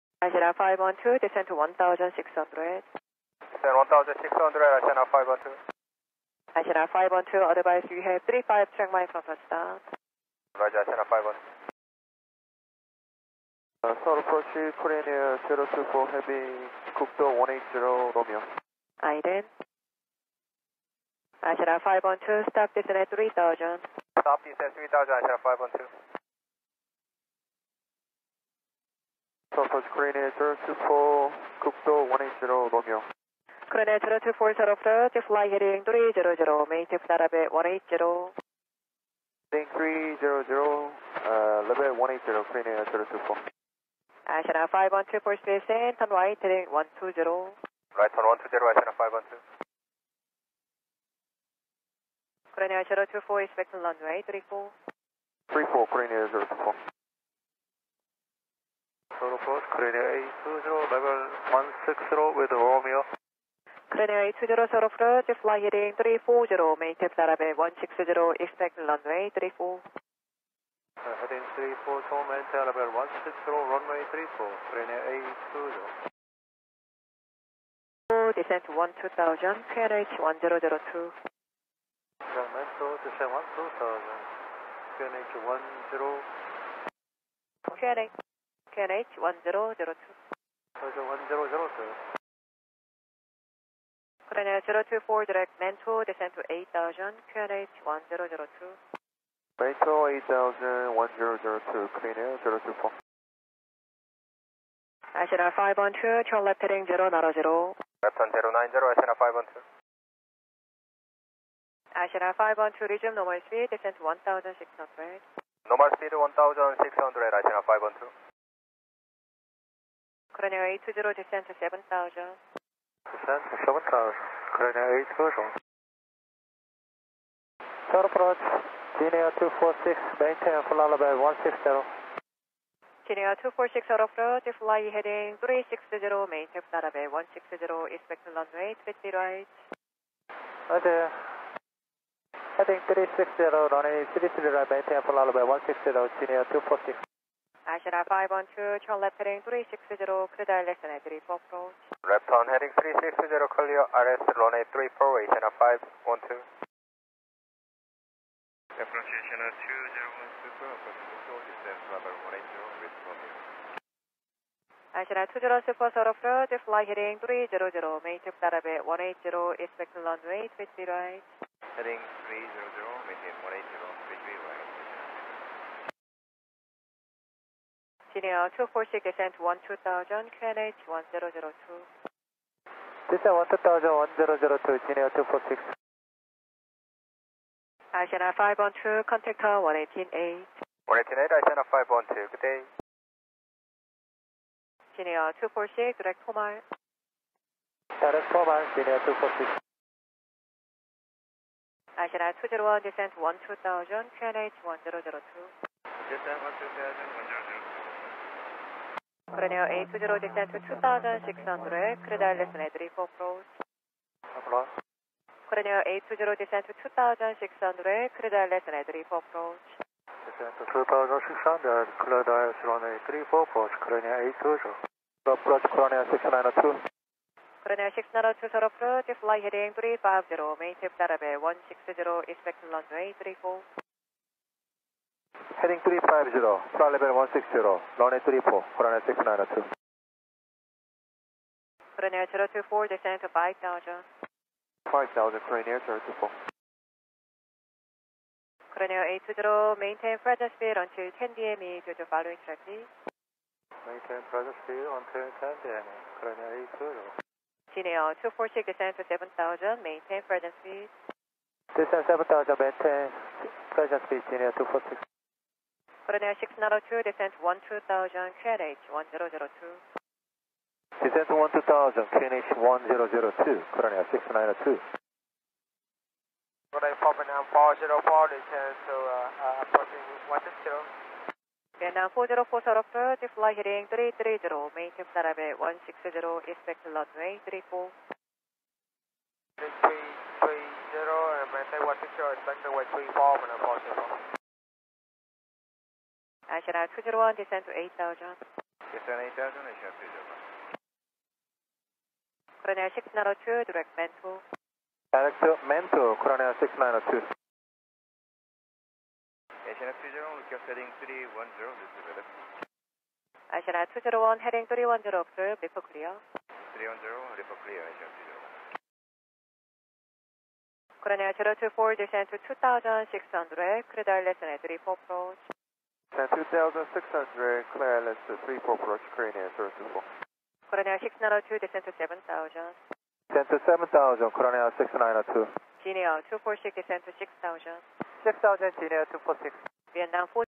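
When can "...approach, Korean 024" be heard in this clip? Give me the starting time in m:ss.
5:28.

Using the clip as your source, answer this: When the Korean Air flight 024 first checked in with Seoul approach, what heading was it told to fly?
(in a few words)
300.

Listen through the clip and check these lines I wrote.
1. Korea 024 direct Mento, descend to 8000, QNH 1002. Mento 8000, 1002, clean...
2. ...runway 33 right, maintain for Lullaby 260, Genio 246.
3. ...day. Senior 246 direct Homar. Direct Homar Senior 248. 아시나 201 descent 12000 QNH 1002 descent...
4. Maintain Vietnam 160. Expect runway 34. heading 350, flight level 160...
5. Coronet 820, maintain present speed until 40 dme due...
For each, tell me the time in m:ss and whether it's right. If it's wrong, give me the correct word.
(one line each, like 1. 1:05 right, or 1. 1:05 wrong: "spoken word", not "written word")
1. 1:34 right
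2. 2:23 wrong: "160", not "260"
3. 3:12 wrong: "246", not "248"
4. 3:50 wrong: "Darabay", not "Vietnam"
5. 4:08 wrong: "10", not "40".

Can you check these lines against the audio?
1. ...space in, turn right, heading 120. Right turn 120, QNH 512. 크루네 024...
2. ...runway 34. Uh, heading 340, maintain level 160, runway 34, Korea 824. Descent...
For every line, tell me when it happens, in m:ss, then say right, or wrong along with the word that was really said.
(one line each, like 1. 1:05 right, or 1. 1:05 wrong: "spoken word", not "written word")
1. 0:45 wrong: "Asiana", not "QNH"
2. 1:08 wrong: "820", not "824".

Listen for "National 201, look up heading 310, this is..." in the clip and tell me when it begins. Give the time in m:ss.
5:09.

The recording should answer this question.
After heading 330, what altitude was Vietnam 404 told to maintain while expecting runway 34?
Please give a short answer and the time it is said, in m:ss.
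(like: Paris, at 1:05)
160, at 4:44.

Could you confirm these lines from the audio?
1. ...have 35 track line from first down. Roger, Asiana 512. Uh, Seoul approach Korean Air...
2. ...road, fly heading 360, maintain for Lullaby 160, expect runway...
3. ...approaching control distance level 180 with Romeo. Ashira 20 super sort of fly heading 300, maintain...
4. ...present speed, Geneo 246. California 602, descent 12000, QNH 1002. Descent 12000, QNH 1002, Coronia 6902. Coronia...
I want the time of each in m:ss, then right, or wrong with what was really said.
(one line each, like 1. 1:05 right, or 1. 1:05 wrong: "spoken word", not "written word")
1. 0:08 right
2. 2:14 right
3. 2:40 right
4. 4:23 right.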